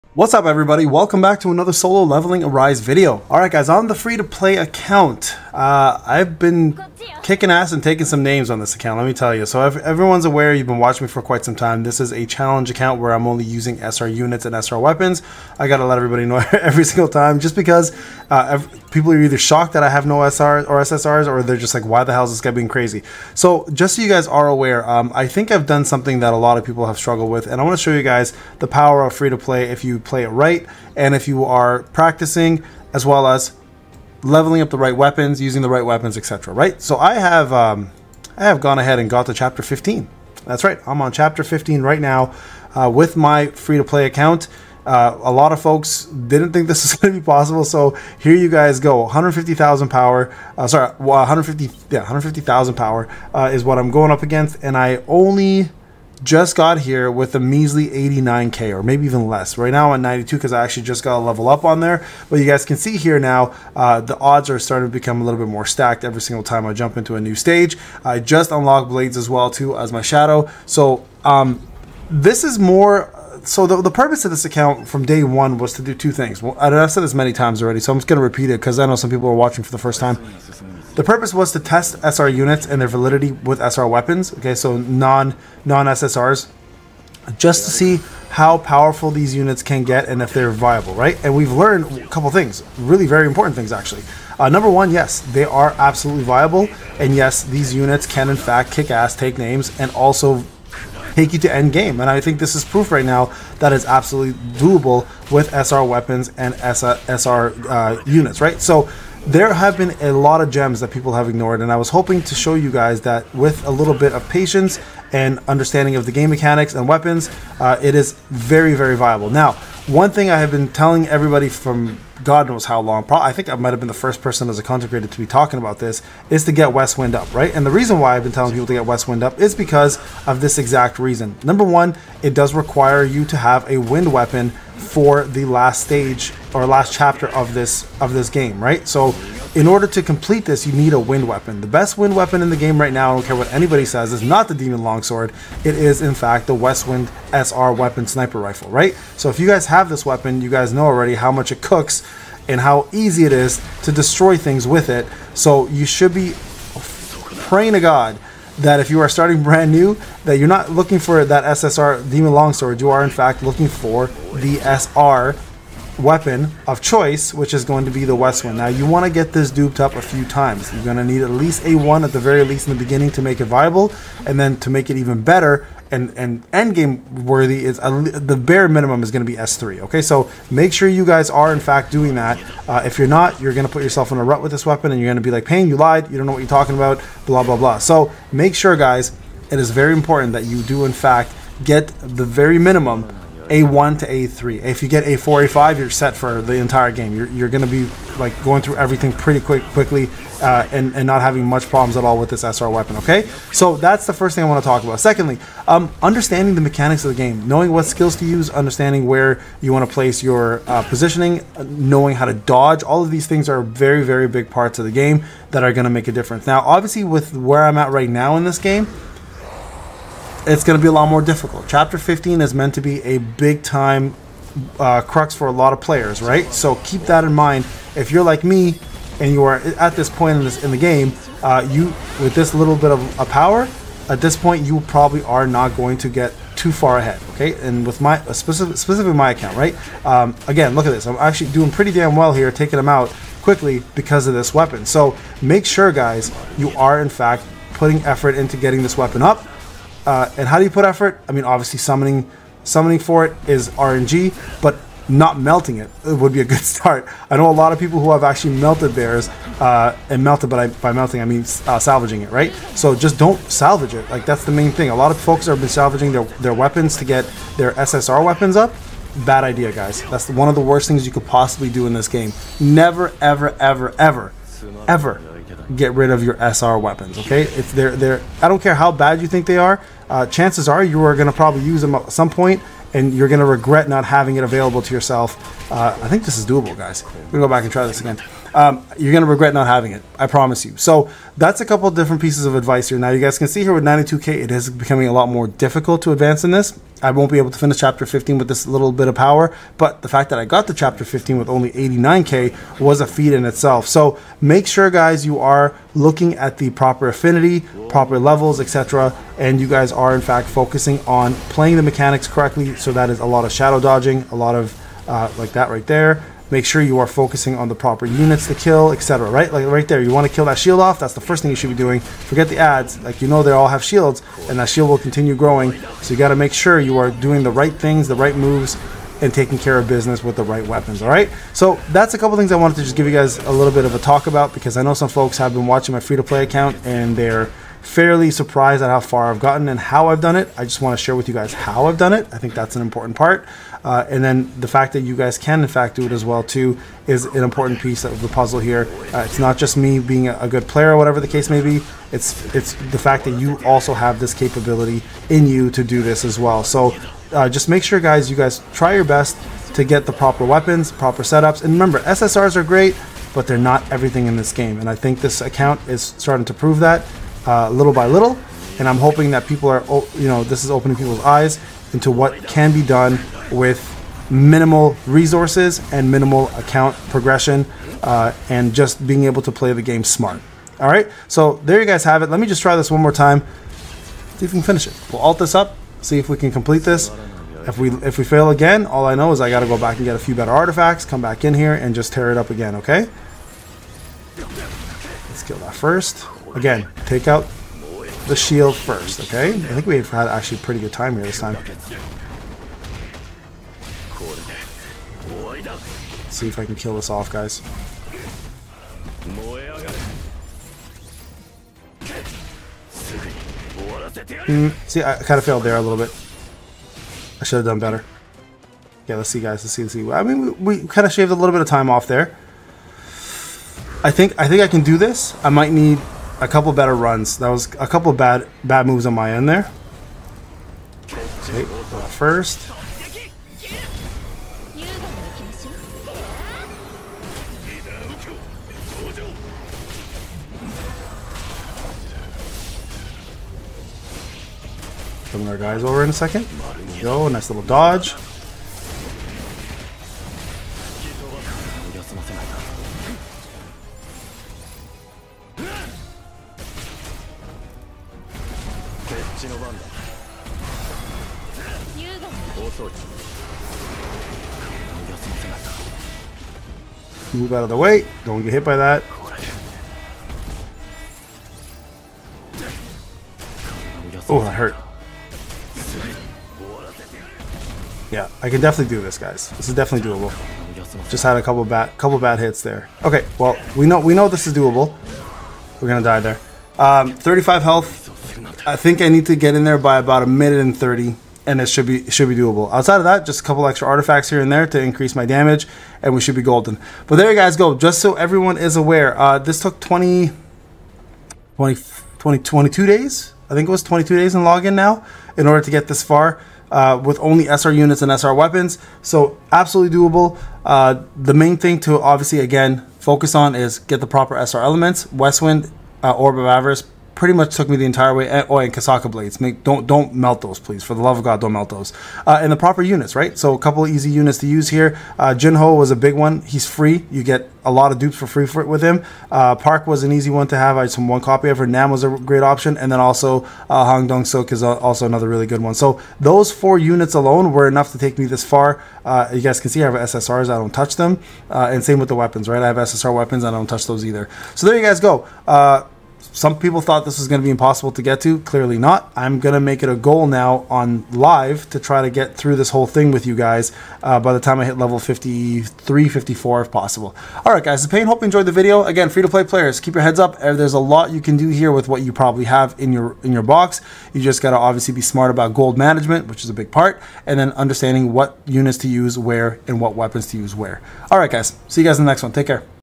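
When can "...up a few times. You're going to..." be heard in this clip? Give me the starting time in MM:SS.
02:49.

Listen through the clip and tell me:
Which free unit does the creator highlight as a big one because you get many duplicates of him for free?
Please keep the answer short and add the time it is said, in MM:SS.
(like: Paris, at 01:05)
Jinho, at 08:45.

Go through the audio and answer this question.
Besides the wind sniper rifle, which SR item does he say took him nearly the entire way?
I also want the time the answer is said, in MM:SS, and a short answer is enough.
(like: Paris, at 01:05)
Orb of Avarice, at 08:36.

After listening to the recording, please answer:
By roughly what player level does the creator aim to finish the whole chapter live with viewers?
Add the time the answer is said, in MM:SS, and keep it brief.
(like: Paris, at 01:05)
53 or 54, at 09:14.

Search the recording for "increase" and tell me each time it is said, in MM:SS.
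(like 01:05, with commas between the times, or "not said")
08:14.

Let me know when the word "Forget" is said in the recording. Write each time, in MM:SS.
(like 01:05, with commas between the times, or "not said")
05:22.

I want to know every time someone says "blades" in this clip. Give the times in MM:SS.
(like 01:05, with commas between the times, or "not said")
01:08, 08:39.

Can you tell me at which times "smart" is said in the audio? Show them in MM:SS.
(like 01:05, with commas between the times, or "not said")
06:20, 09:25.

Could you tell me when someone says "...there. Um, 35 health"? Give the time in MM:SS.
08:06.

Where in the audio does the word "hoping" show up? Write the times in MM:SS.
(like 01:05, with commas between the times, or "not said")
01:51, 06:08.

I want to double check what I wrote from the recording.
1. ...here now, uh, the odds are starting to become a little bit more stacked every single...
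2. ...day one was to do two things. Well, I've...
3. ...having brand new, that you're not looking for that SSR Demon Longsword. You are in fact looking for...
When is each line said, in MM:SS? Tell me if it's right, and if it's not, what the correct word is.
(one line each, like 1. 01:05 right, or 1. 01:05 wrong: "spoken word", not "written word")
1. 01:02 right
2. 01:15 right
3. 02:39 wrong: "starting", not "having".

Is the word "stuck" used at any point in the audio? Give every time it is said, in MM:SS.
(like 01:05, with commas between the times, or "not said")
not said.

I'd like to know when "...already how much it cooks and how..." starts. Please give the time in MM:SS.
02:30.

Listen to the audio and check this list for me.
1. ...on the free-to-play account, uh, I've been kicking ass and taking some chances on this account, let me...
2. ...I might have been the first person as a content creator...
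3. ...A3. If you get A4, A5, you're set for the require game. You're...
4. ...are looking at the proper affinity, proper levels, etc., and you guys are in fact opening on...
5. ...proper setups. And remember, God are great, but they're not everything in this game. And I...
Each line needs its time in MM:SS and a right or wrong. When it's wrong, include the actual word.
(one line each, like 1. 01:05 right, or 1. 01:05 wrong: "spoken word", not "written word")
1. 00:03 wrong: "names", not "chances"
2. 02:03 right
3. 03:14 wrong: "entire", not "require"
4. 05:05 wrong: "focusing", not "opening"
5. 06:00 wrong: "SSRs", not "God".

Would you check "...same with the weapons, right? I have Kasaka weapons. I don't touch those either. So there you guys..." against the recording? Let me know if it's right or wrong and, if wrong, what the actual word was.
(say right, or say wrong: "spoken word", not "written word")
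wrong: "SSR", not "Kasaka".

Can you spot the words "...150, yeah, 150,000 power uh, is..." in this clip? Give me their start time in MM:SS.
00:50.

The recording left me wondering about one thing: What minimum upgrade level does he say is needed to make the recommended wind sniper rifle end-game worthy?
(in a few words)
S3.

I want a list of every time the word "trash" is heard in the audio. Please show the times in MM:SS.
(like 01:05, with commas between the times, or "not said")
not said.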